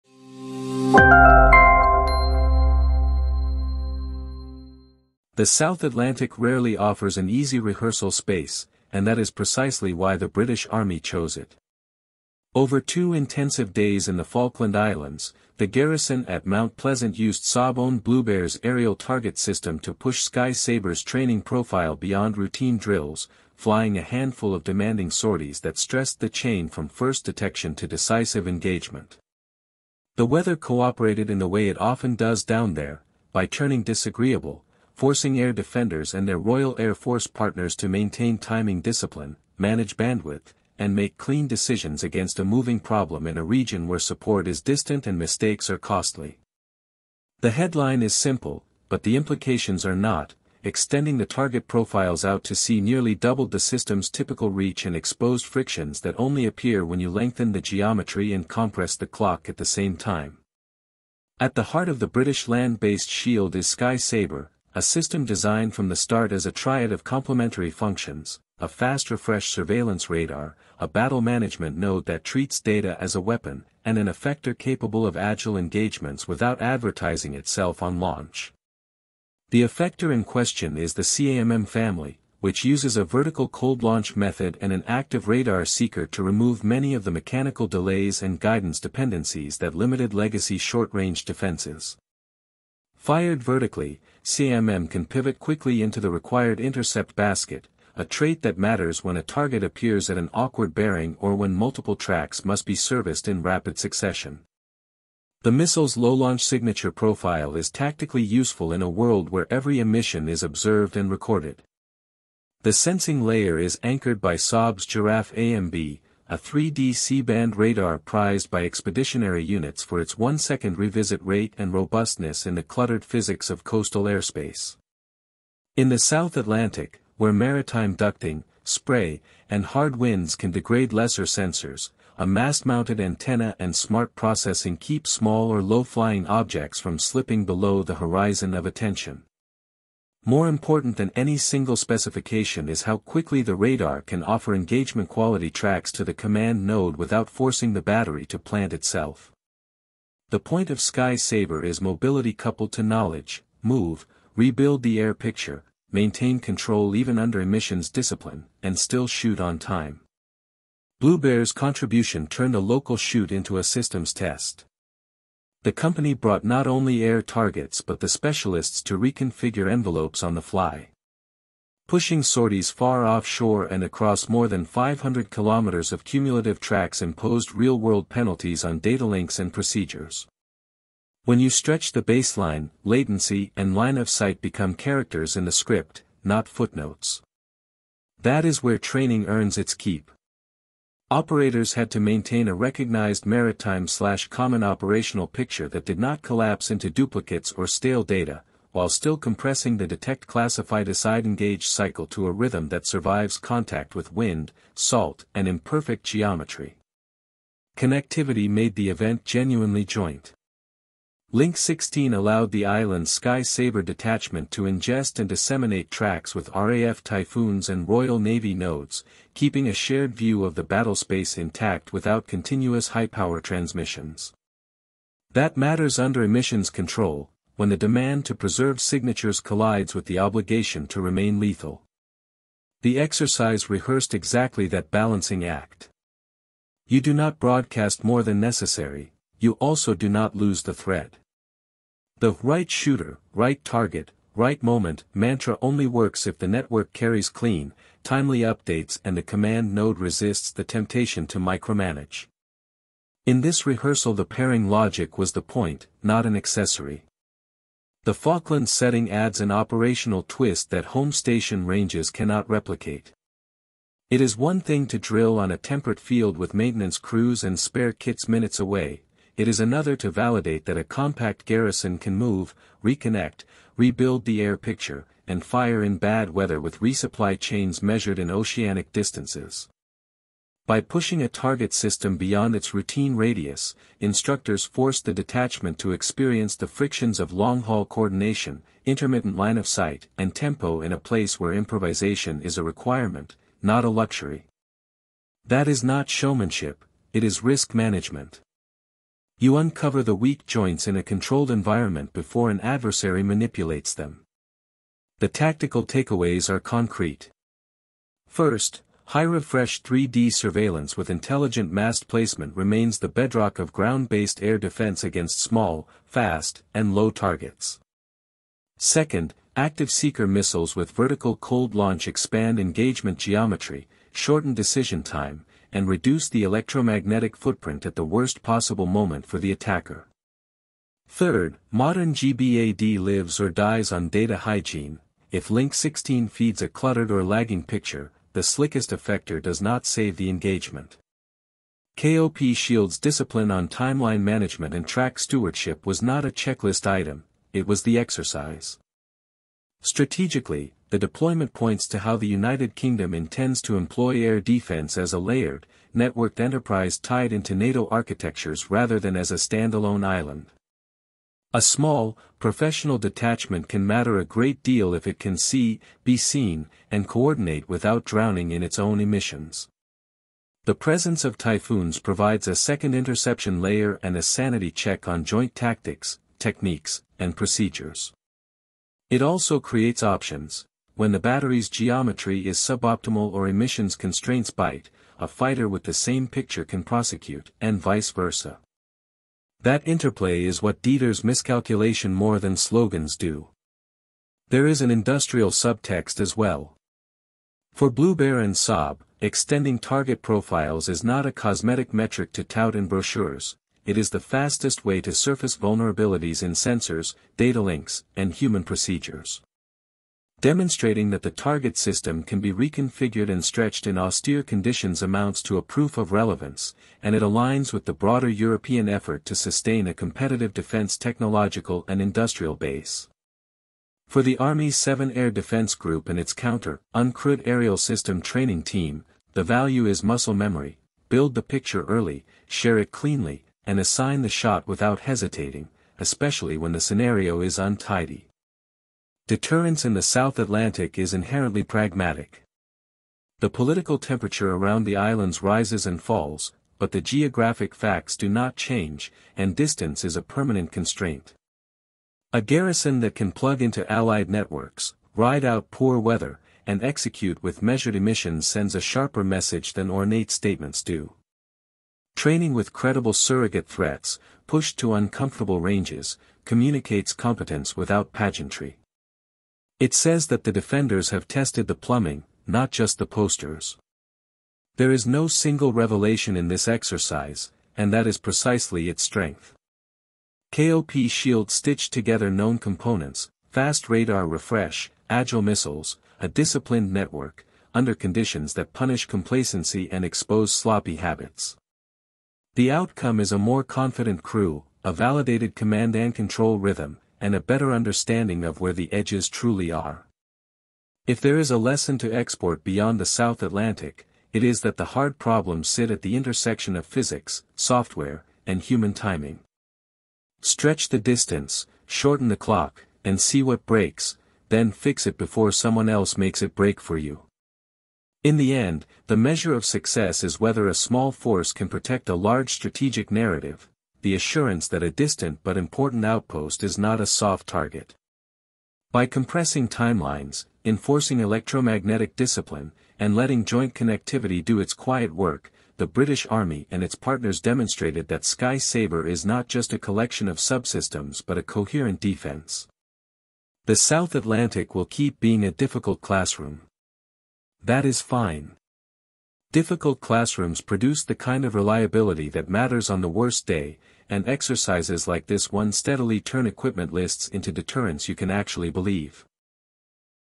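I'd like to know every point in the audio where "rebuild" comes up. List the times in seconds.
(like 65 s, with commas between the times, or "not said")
154 s, 273 s.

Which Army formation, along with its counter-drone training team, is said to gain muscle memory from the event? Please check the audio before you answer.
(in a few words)
7 Air Defense Group.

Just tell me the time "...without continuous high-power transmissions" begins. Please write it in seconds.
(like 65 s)
221 s.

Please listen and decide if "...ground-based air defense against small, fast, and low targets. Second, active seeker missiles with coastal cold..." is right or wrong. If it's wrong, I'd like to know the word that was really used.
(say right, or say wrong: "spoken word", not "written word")
wrong: "vertical", not "coastal".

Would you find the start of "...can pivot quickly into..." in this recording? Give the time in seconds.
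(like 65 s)
94 s.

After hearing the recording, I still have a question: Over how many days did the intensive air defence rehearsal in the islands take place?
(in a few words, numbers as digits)
2.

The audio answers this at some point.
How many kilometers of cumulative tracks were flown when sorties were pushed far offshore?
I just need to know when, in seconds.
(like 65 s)
174 s.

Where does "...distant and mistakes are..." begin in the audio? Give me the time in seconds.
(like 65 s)
44 s.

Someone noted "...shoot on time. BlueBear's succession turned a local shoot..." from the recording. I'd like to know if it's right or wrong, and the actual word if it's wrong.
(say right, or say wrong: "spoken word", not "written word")
wrong: "contribution", not "succession".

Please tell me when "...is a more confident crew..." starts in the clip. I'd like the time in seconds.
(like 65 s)
493 s.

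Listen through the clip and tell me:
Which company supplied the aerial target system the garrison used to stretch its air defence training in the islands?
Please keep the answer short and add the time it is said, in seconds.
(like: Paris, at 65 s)
Sawbone BlueBear, at 17 s.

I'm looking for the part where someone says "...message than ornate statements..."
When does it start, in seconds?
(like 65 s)
459 s.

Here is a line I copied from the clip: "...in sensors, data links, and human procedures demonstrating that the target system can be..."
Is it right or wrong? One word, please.
right.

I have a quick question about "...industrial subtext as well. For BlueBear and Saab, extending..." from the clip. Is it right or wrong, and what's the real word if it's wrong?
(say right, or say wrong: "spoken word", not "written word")
right.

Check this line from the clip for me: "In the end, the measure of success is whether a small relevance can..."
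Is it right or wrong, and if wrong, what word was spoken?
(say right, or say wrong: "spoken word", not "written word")
wrong: "force", not "relevance".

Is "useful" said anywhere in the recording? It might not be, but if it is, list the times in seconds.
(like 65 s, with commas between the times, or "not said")
108 s.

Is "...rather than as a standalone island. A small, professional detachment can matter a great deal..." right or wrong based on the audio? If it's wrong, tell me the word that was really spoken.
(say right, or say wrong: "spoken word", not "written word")
right.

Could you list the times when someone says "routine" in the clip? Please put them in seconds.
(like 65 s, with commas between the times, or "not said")
22 s, 282 s.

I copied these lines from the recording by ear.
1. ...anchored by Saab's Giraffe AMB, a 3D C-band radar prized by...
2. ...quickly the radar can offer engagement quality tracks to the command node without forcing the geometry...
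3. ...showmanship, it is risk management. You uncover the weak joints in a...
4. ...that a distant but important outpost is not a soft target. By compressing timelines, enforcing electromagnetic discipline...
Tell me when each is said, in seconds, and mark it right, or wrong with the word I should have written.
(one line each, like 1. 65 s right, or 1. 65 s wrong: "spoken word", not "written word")
1. 113 s right
2. 142 s wrong: "battery", not "geometry"
3. 296 s right
4. 524 s right.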